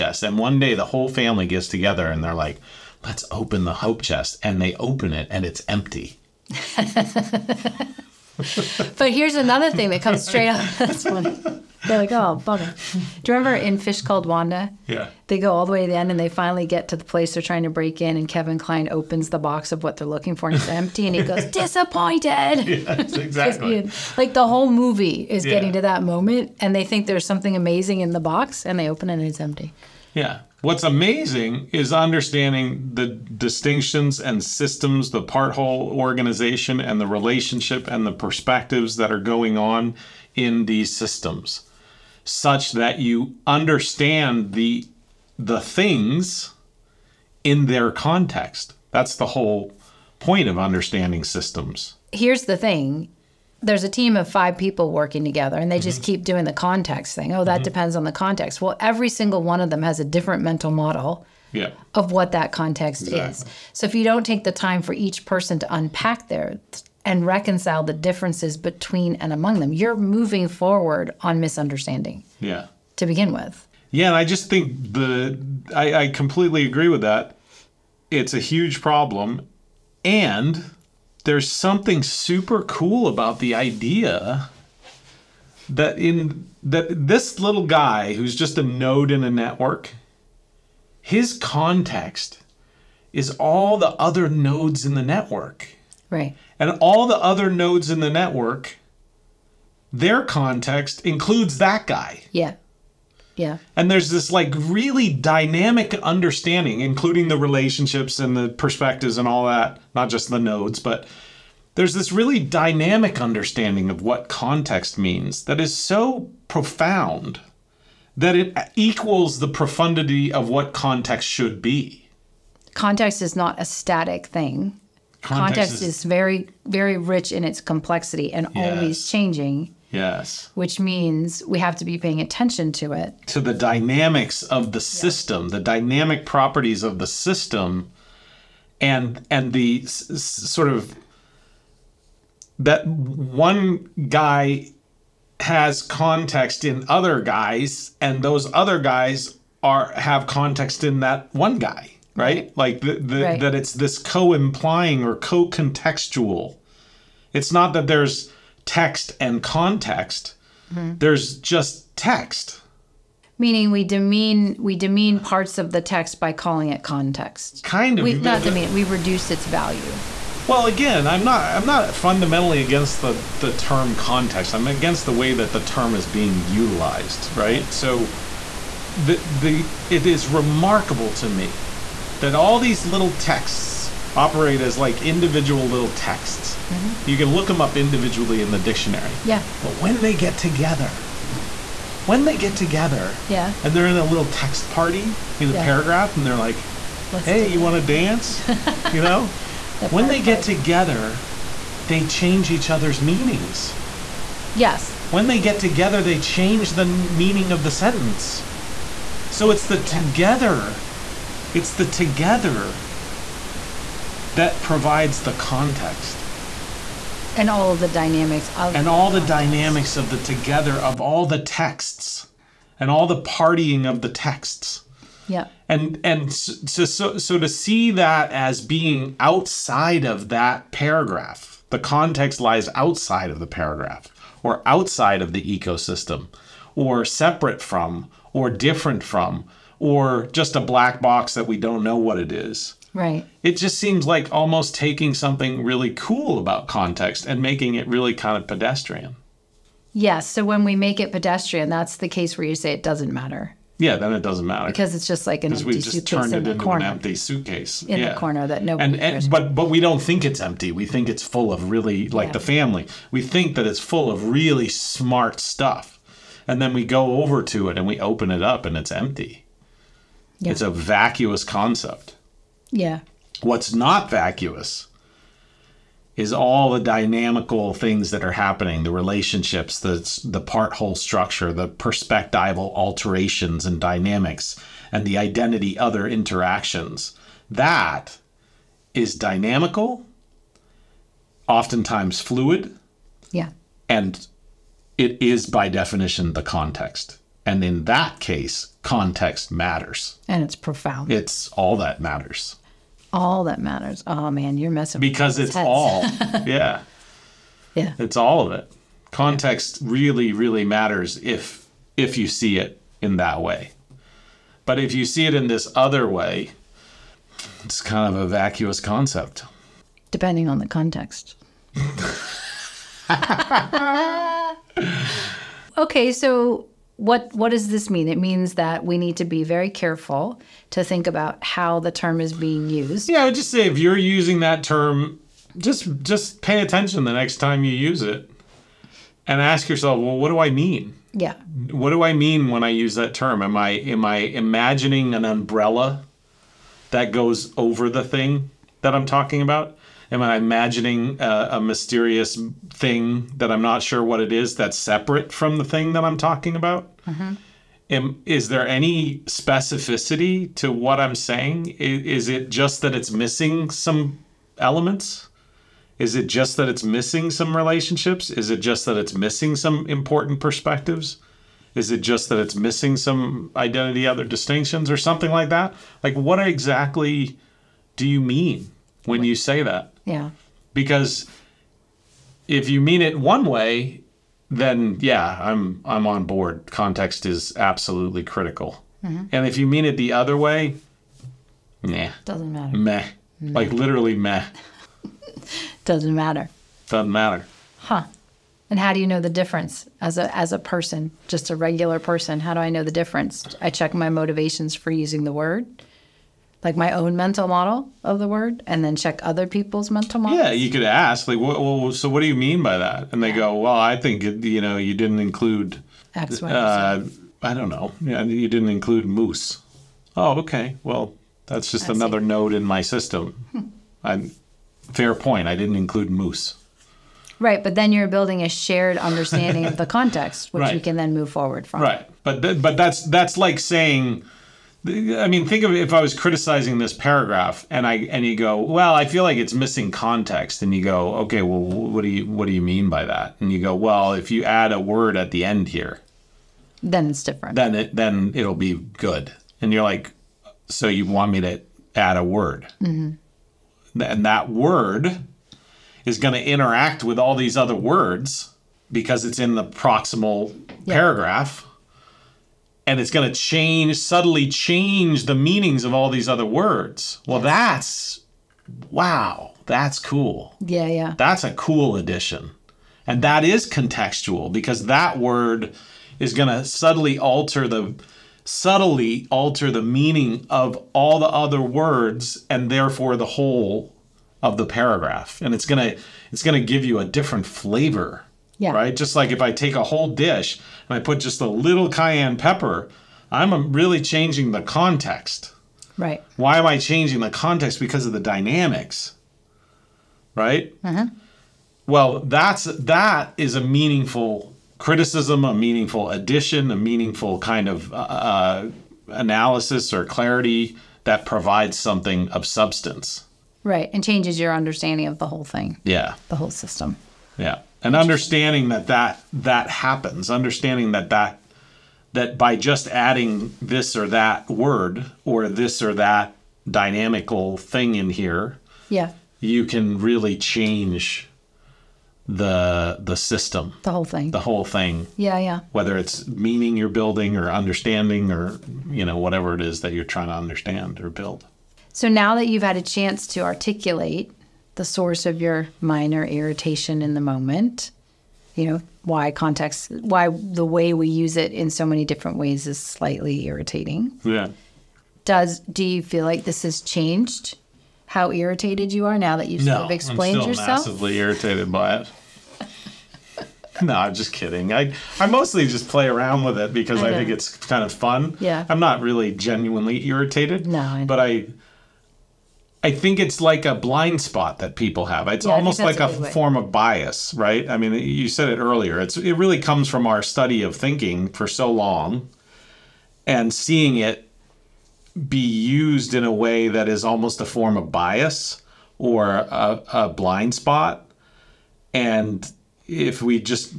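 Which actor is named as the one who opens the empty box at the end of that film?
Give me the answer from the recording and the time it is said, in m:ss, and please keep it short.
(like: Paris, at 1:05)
Kevin Kline, at 0:18.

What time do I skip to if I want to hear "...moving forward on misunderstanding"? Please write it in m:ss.
1:09.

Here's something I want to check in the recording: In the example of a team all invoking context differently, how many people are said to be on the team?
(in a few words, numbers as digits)
5.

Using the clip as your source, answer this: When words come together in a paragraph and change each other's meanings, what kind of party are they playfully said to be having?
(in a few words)
Text party.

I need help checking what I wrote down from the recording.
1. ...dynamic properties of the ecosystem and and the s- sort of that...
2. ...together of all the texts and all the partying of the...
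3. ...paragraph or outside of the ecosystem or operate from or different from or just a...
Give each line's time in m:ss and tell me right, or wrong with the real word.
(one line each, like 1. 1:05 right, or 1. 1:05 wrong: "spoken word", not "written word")
1. 2:15 wrong: "system", not "ecosystem"
2. 3:40 right
3. 3:53 wrong: "separate", not "operate".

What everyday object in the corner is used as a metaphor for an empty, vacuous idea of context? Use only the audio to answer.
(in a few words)
Empty suitcase.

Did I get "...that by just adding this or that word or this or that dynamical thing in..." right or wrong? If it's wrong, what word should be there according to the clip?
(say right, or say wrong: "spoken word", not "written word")
right.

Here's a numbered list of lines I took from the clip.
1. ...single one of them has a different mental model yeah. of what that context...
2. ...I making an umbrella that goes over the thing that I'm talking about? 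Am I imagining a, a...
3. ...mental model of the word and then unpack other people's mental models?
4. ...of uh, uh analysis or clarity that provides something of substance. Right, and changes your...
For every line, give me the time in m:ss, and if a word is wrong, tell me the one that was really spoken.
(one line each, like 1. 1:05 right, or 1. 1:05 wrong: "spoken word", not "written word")
1. 0:59 right
2. 5:44 wrong: "imagining", not "making"
3. 6:47 wrong: "check", not "unpack"
4. 8:27 right.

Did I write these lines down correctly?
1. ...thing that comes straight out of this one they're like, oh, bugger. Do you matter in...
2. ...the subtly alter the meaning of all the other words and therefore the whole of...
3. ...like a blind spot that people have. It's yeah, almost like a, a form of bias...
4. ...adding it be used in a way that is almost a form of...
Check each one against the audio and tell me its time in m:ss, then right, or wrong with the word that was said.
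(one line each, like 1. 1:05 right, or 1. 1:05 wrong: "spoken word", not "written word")
1. 0:09 wrong: "remember", not "matter"
2. 7:57 right
3. 9:33 right
4. 9:43 wrong: "seeing", not "adding".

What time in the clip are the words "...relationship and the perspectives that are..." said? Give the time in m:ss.
0:37.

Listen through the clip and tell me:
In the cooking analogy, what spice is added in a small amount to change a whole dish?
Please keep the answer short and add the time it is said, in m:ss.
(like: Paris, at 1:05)
Cayenne pepper, at 8:11.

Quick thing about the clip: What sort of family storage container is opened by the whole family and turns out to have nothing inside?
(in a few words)
Hope chest.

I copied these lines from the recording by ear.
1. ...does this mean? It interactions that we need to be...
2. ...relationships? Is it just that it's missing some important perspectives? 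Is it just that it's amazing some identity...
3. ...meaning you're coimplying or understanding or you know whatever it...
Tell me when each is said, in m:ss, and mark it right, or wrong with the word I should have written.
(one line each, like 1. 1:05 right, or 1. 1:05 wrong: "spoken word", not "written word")
1. 5:27 wrong: "means", not "interactions"
2. 6:07 wrong: "missing", not "amazing"
3. 8:56 wrong: "building", not "coimplying".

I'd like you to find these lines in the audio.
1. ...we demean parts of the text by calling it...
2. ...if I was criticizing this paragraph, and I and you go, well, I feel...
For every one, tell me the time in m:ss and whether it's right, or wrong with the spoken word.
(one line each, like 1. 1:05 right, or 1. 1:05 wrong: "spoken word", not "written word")
1. 2:44 right
2. 7:15 right.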